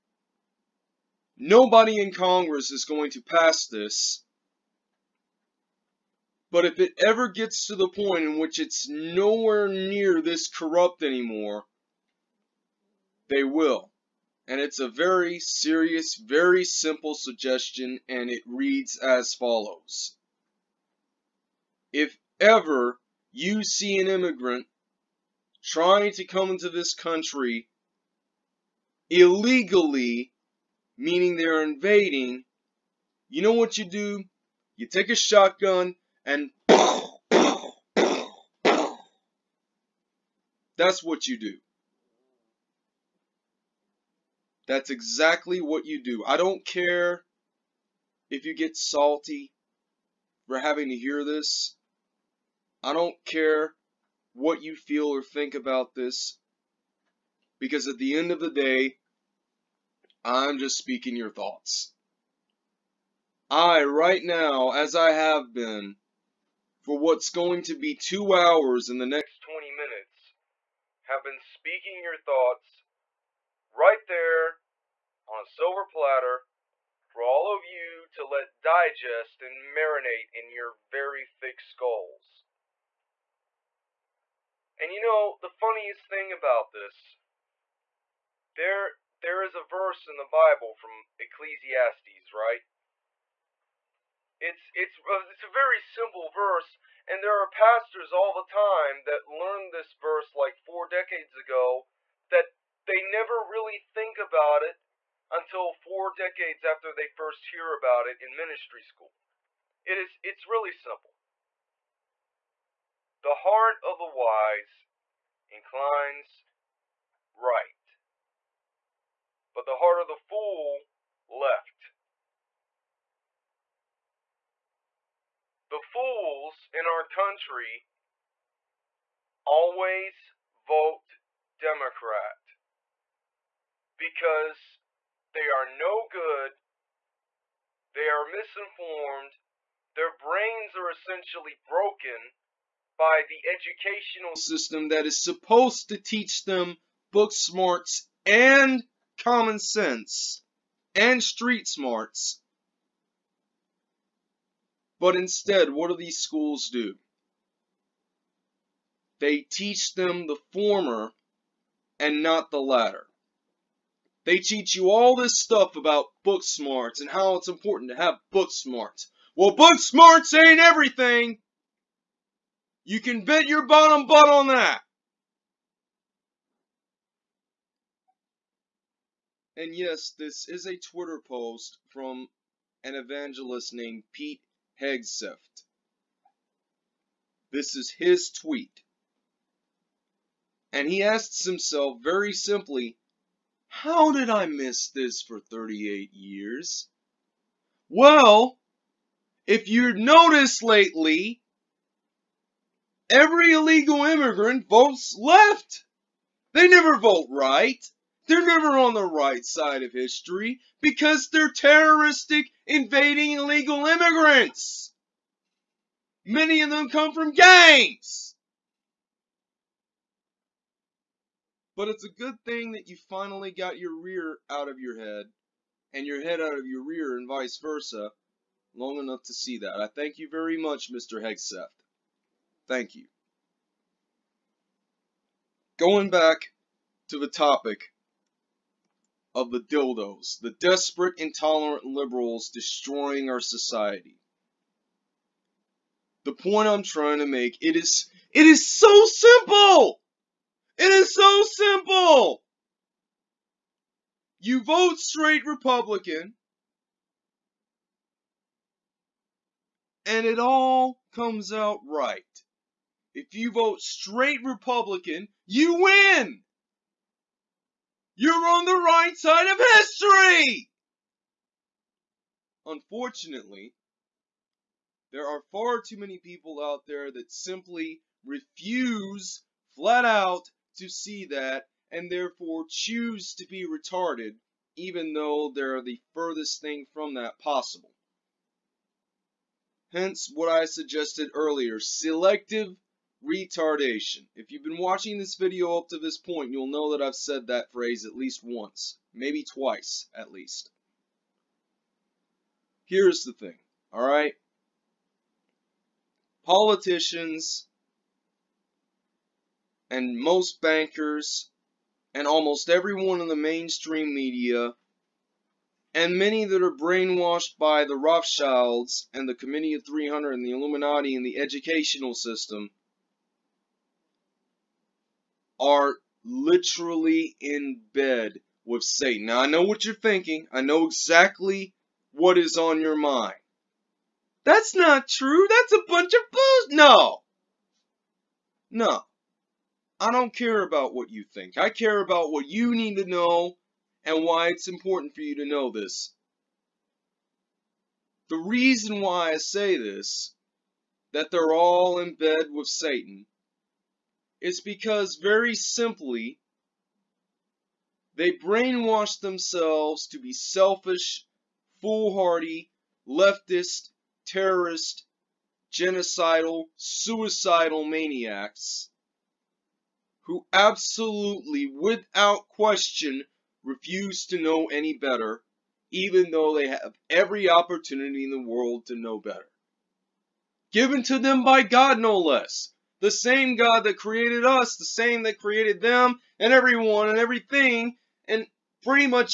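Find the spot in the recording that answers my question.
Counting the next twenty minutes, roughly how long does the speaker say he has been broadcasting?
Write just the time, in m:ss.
1:07.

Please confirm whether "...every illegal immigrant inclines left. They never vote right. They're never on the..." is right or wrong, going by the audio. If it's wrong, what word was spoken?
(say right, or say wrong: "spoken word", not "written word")
wrong: "votes", not "inclines".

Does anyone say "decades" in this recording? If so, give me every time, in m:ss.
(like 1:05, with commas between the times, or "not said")
1:40, 1:46.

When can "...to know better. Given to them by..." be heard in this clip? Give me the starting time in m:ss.
6:18.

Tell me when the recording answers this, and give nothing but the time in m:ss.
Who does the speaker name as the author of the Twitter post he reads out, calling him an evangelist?
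3:04.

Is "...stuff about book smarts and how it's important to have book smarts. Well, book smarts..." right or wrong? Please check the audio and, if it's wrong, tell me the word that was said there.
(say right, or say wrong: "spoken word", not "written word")
right.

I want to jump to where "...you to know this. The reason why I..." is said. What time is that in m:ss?
5:45.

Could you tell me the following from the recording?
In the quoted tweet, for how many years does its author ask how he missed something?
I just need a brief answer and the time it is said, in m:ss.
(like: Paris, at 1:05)
38 years, at 3:15.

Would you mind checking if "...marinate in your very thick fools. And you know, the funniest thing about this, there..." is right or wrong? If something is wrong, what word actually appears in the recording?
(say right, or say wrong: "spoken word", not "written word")
wrong: "skulls", not "fools".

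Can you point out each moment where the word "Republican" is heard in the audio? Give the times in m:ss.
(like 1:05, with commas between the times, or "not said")
4:15, 4:24.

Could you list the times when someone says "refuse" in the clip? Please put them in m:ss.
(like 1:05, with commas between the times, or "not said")
4:38, 6:13.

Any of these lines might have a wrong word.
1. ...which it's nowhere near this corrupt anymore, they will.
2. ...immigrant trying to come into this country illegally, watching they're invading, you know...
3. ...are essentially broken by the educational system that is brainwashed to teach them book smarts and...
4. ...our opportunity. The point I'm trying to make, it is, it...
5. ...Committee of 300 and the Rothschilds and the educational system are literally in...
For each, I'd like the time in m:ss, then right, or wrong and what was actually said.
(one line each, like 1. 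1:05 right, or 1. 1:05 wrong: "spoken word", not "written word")
1. 0:08 right
2. 0:24 wrong: "meaning", not "watching"
3. 2:20 wrong: "supposed", not "brainwashed"
4. 4:03 wrong: "society", not "opportunity"
5. 5:19 wrong: "Illuminati", not "Rothschilds".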